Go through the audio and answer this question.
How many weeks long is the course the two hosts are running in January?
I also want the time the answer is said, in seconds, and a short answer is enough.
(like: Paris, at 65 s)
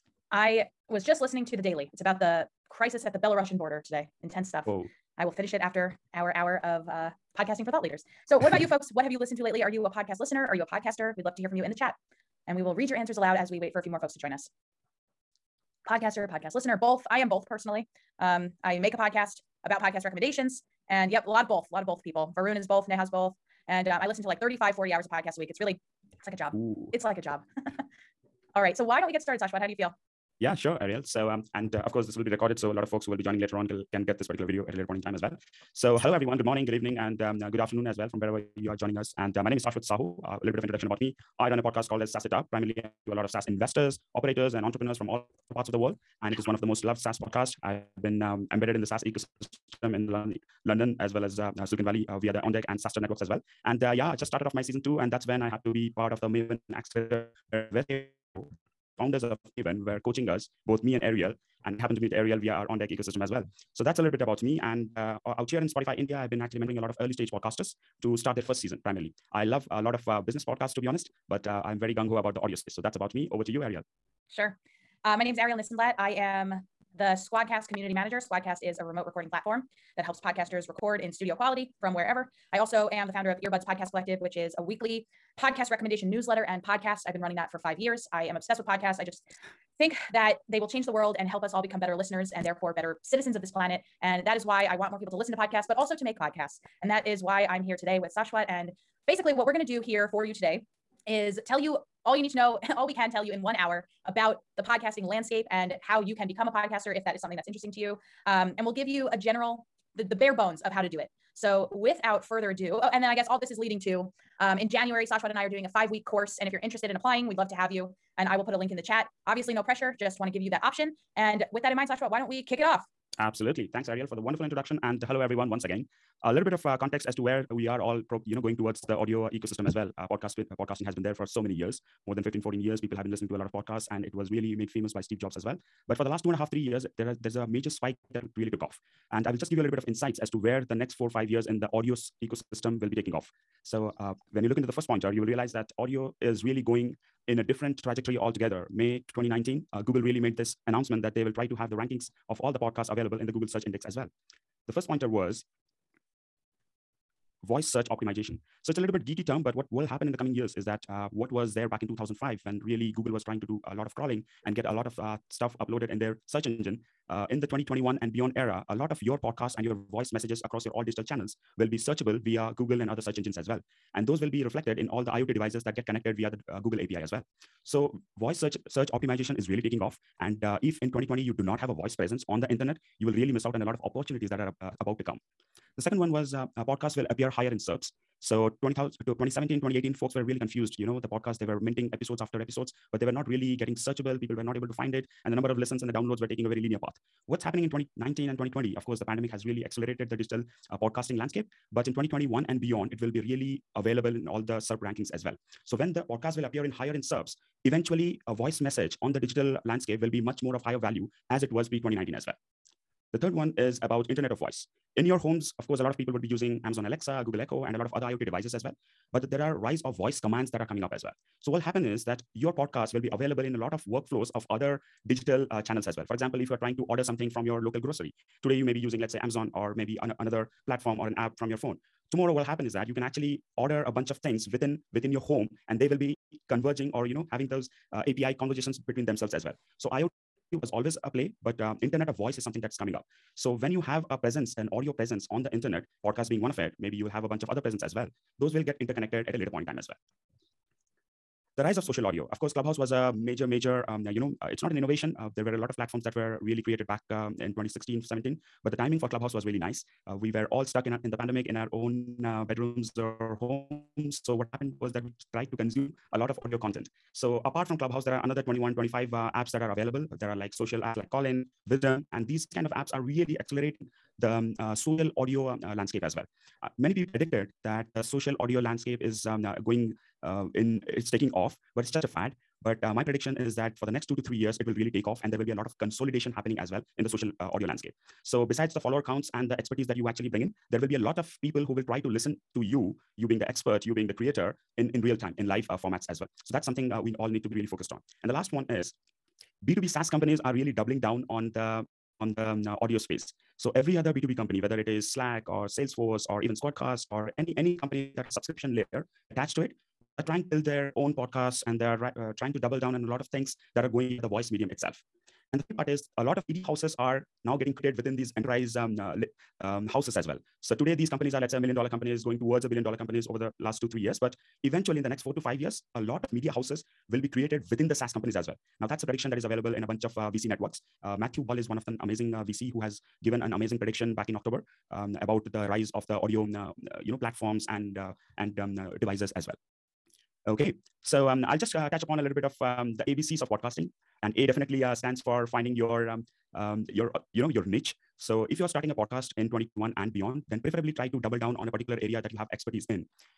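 5, at 115 s.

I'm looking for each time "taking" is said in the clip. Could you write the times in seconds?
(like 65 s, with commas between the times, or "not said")
142 s, 179 s, 196 s, 281 s.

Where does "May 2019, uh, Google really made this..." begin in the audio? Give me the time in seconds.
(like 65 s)
148 s.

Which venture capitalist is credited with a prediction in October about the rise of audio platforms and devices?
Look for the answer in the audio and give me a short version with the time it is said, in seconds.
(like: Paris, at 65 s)
Matthew Ball, at 331 s.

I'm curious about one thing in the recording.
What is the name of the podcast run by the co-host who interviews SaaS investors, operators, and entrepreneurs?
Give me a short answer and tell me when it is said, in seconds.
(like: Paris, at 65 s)
SaaS It Up, at 42 s.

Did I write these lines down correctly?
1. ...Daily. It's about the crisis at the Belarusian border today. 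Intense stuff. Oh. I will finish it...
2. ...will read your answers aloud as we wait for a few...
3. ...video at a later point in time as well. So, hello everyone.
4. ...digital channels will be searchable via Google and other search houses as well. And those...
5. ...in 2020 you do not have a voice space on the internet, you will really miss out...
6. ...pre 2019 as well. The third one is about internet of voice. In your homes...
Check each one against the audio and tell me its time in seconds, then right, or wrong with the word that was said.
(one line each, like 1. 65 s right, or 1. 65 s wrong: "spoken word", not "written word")
1. 1 s right
2. 12 s right
3. 34 s right
4. 170 s wrong: "engines", not "houses"
5. 180 s wrong: "presence", not "space"
6. 211 s right.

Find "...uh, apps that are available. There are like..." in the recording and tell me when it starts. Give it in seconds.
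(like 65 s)
269 s.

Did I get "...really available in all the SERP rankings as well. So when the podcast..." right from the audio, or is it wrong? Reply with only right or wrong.
right.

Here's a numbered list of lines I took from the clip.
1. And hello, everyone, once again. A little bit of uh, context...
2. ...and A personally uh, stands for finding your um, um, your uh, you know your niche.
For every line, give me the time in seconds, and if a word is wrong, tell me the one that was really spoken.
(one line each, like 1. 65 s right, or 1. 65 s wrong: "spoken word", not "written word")
1. 124 s right
2. 344 s wrong: "definitely", not "personally".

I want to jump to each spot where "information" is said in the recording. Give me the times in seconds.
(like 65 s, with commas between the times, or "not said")
not said.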